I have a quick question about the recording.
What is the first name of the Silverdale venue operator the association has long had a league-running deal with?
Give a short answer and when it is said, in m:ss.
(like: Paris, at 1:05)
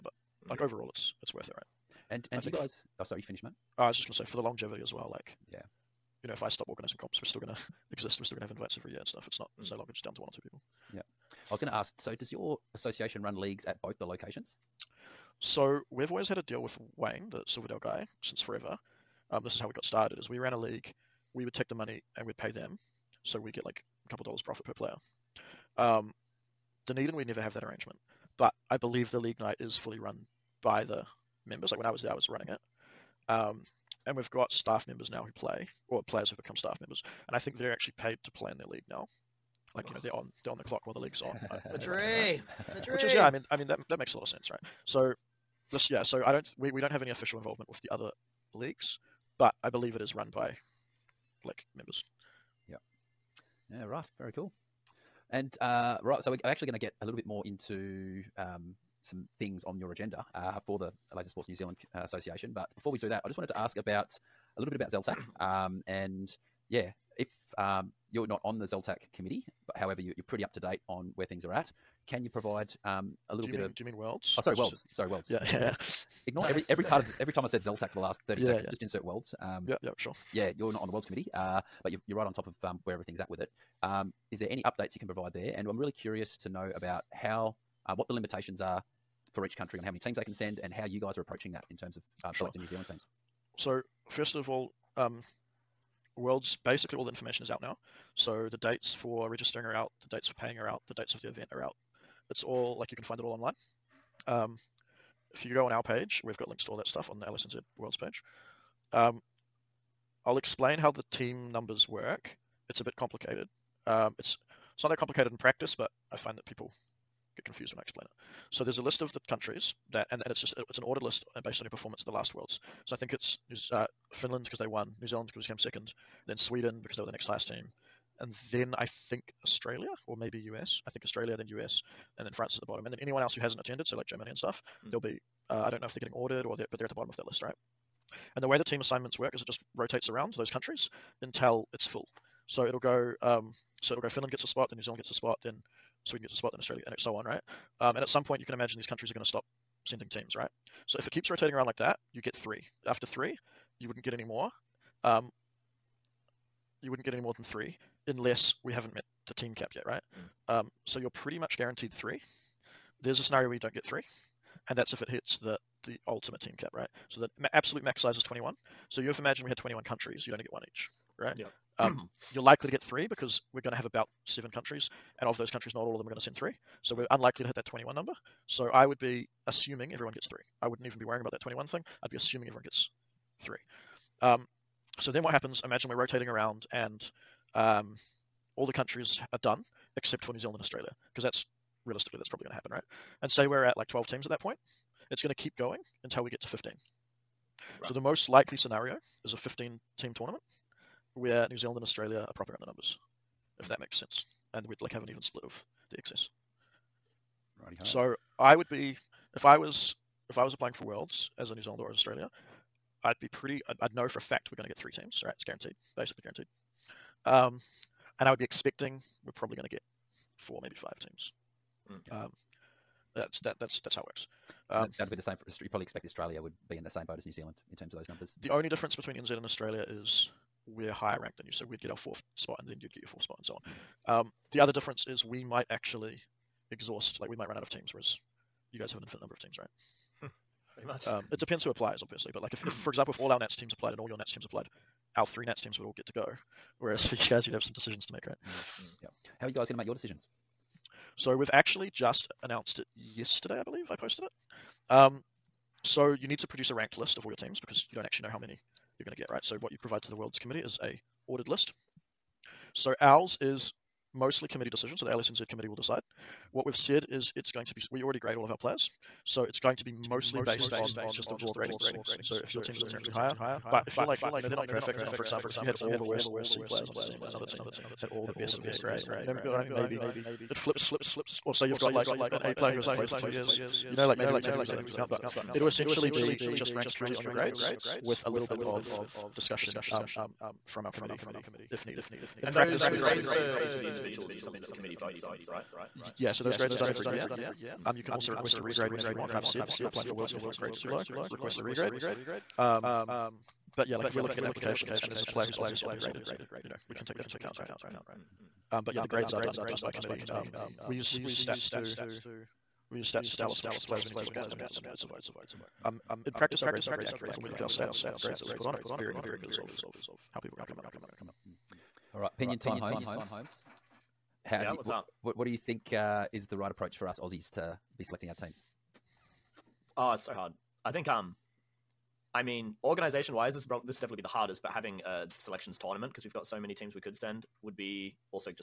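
Wayne, at 0:16.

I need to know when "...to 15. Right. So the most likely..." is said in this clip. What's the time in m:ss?
3:16.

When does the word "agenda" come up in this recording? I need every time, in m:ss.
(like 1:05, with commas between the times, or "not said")
0:59.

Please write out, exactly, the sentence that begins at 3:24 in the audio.
And we'd like have an even split of the excess.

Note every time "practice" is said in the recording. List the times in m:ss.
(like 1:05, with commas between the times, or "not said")
1:55, 4:52, 5:16.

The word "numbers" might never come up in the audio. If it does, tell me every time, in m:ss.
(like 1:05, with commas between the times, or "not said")
1:51, 2:57, 3:22, 3:48, 3:59.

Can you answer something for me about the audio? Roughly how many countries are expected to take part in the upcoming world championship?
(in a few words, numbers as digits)
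7.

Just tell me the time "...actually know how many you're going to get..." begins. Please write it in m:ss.
4:18.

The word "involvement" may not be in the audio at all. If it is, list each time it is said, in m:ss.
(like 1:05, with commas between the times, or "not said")
0:47.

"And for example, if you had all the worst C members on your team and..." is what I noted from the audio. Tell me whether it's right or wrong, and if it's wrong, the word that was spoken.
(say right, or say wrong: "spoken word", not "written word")
wrong: "players", not "members".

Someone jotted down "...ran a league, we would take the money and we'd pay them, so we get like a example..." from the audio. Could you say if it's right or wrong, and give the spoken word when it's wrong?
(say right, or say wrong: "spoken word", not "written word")
wrong: "couple", not "example".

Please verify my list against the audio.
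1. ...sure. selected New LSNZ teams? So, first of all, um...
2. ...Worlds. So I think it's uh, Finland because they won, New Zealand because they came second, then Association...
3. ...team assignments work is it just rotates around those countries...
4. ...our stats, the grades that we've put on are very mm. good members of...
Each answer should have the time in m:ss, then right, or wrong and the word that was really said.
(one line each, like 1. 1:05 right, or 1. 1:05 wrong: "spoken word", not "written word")
1. 1:32 wrong: "Zealand", not "LSNZ"
2. 2:02 wrong: "Sweden", not "Association"
3. 2:18 right
4. 5:17 wrong: "predictors", not "members".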